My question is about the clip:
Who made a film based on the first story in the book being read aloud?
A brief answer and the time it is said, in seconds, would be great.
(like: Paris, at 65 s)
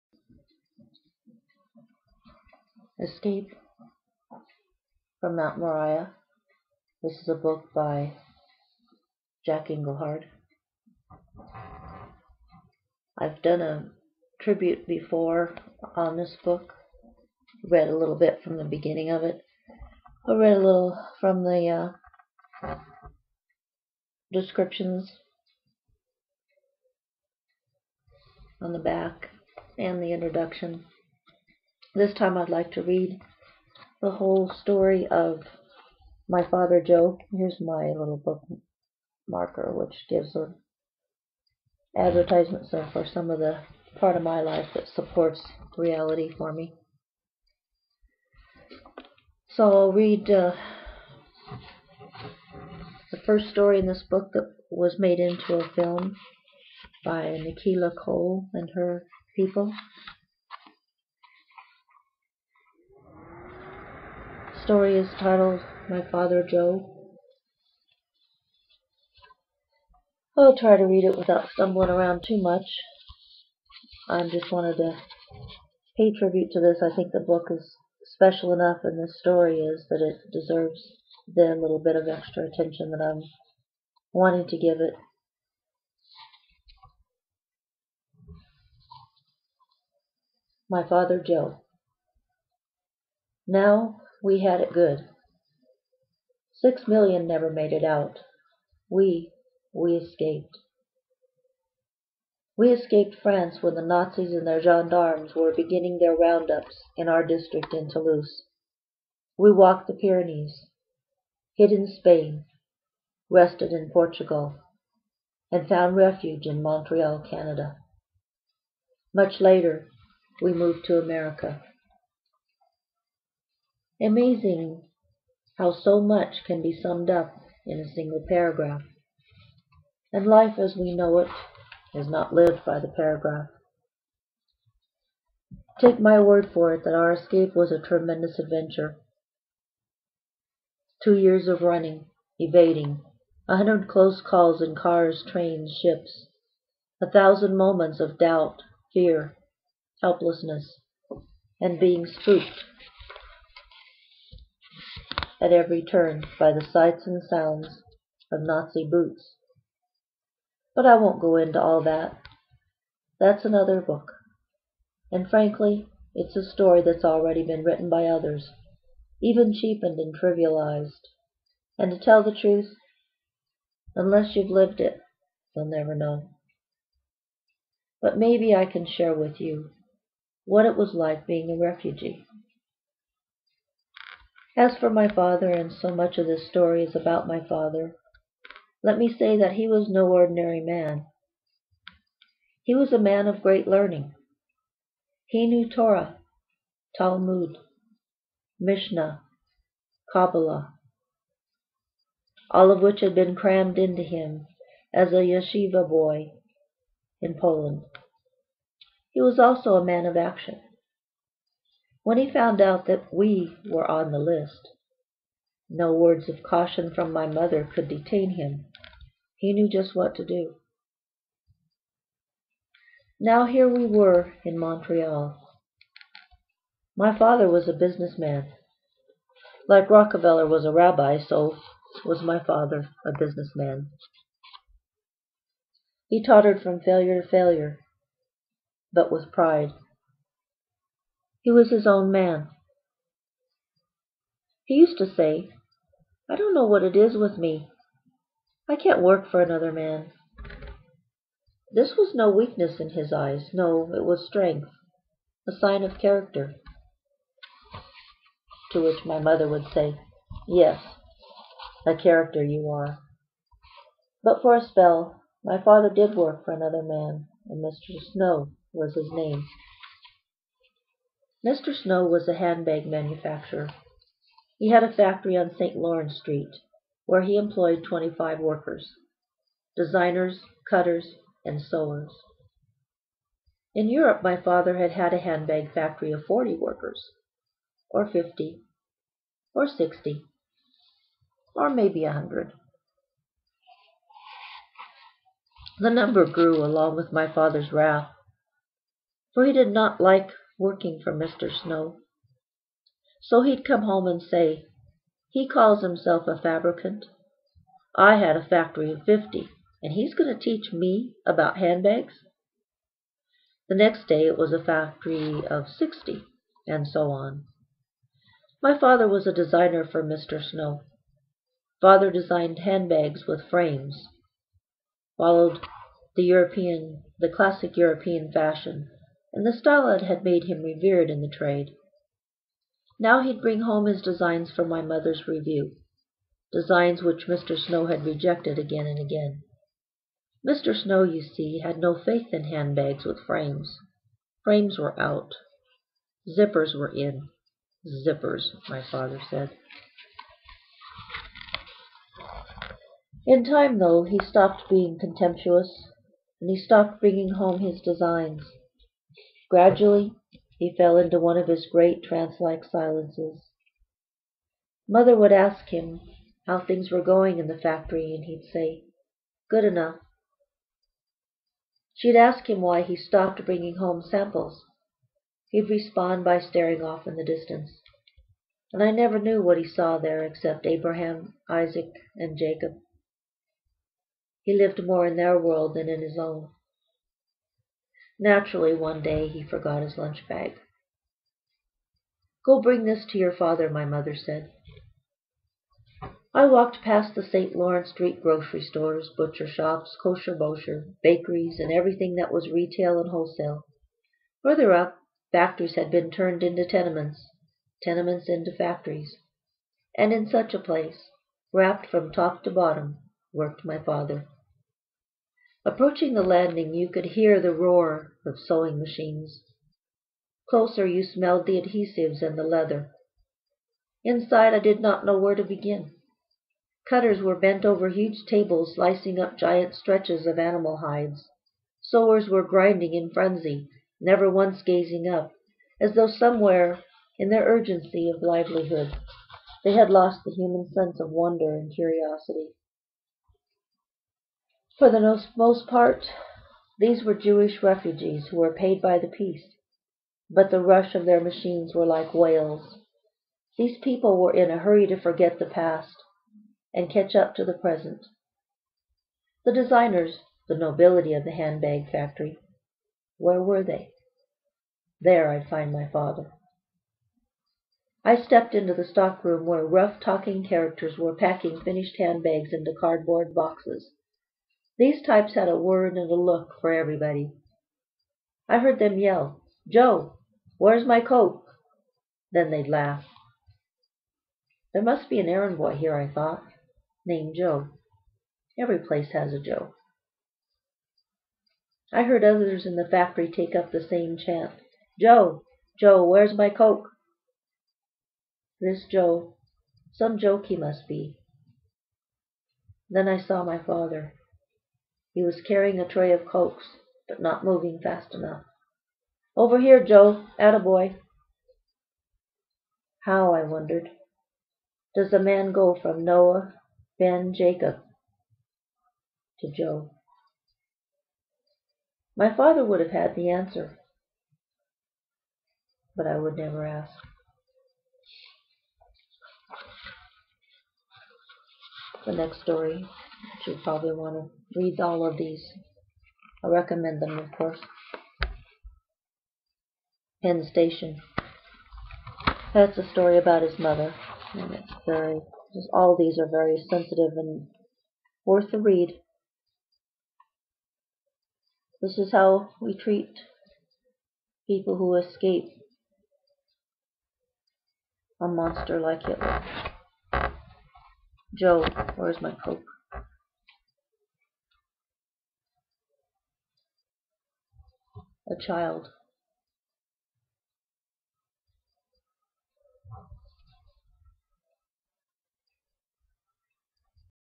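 Nikila Cole, at 57 s.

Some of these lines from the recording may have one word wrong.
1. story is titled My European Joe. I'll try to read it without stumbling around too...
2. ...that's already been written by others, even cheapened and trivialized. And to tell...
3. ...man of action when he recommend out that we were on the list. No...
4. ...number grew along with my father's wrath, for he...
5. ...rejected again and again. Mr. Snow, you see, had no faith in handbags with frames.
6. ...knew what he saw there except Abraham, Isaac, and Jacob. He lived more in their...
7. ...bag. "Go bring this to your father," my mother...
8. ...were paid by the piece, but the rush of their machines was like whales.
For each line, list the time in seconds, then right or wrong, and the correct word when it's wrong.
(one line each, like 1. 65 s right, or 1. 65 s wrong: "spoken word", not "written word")
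1. 64 s wrong: "Father", not "European"
2. 166 s right
3. 209 s wrong: "found", not "recommend"
4. 295 s right
5. 338 s right
6. 379 s right
7. 390 s right
8. 448 s right.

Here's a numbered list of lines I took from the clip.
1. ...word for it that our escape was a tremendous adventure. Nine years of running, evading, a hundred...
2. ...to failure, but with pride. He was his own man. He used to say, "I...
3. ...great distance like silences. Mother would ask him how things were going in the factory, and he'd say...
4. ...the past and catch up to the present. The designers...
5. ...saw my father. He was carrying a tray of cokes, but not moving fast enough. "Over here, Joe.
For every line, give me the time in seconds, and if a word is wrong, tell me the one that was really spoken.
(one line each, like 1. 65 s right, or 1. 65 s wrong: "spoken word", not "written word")
1. 136 s wrong: "Two", not "Nine"
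2. 237 s right
3. 361 s wrong: "trance", not "distance"
4. 455 s right
5. 503 s right.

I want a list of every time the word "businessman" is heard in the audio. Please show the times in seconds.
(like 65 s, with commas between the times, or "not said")
227 s, 233 s.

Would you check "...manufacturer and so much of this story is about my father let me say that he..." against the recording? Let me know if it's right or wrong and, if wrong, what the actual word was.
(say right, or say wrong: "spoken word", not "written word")
wrong: "father", not "manufacturer".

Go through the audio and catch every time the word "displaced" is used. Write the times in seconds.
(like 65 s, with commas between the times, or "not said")
not said.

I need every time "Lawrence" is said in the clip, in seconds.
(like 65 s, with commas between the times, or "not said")
275 s, 397 s.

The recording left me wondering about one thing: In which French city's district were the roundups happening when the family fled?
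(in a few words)
Toulouse.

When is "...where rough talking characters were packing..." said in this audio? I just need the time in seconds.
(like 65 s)
469 s.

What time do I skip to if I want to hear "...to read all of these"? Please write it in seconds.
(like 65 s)
534 s.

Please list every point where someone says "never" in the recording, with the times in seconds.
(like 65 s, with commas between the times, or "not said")
97 s, 175 s, 378 s, 434 s, 526 s.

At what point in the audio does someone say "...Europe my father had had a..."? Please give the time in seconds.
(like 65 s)
283 s.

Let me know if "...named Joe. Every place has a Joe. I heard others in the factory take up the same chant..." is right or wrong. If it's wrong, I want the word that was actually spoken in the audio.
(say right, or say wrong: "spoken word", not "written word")
right.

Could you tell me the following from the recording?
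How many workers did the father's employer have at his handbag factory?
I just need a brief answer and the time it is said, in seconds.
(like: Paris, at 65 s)
25, at 277 s.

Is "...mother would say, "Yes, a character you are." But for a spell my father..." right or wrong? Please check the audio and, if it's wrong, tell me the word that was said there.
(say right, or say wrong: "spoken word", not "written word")
right.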